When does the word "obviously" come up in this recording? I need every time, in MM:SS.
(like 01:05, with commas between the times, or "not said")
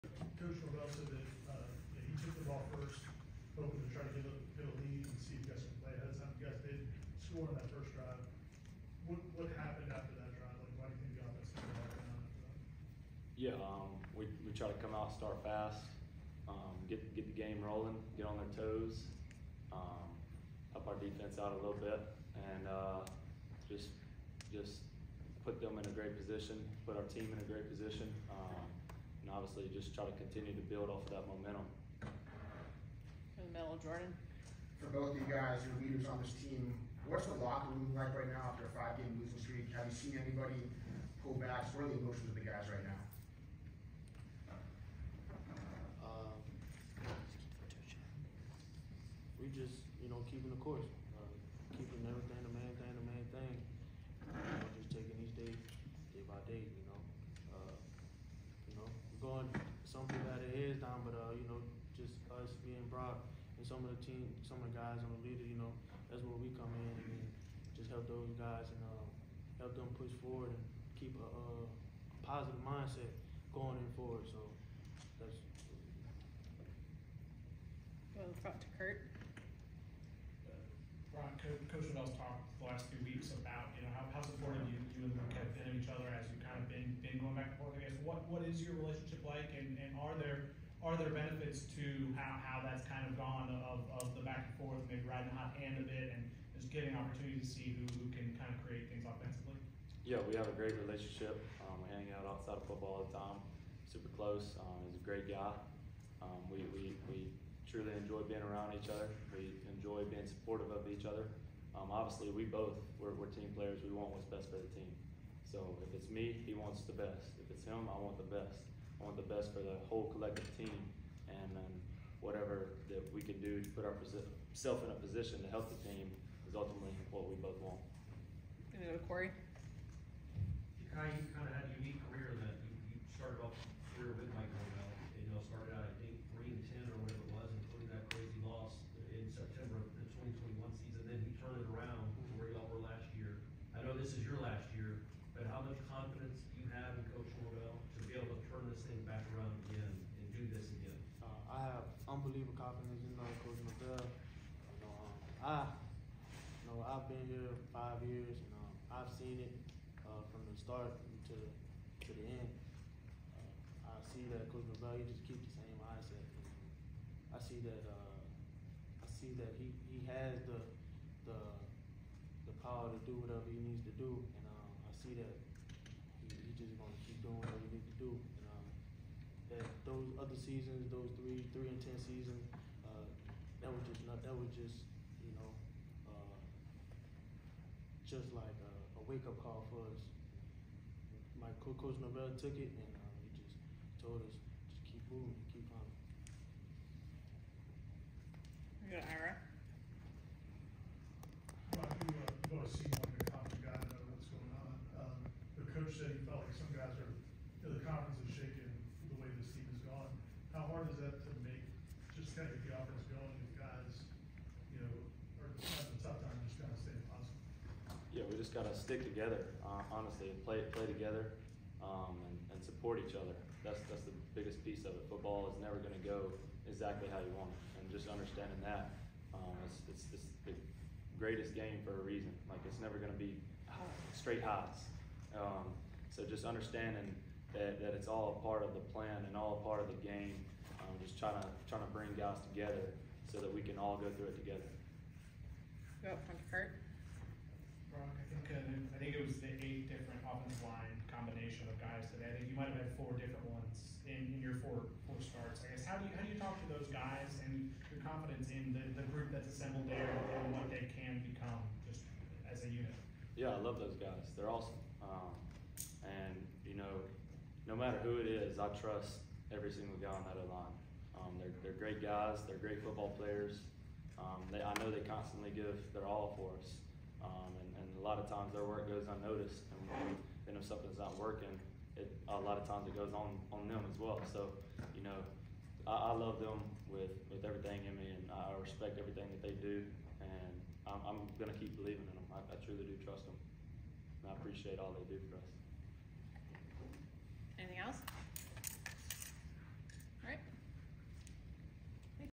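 00:29, 01:51.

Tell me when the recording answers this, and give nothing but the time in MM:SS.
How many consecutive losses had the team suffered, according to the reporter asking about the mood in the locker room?
00:38.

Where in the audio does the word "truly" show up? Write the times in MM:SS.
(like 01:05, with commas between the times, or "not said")
01:47, 04:52.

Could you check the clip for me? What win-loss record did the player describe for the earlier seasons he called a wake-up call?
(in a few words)
3-10.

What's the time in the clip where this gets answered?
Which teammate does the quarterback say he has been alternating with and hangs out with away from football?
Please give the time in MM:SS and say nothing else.
01:25.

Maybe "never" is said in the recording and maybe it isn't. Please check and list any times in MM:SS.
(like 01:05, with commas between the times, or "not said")
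03:45, 03:52.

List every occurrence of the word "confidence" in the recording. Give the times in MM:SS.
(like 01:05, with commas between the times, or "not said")
02:32, 04:18.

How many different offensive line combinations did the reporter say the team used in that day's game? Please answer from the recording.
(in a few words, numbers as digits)
8.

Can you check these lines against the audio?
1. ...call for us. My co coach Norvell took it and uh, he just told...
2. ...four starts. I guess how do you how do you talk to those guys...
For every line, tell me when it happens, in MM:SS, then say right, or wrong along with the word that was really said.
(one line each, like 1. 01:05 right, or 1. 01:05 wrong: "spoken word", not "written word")
1. 03:09 right
2. 04:15 right.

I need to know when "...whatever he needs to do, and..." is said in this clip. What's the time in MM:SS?
02:53.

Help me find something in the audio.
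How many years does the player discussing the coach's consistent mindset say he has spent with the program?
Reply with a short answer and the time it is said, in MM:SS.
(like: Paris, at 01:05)
5, at 02:37.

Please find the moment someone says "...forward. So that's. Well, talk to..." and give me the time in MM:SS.
01:13.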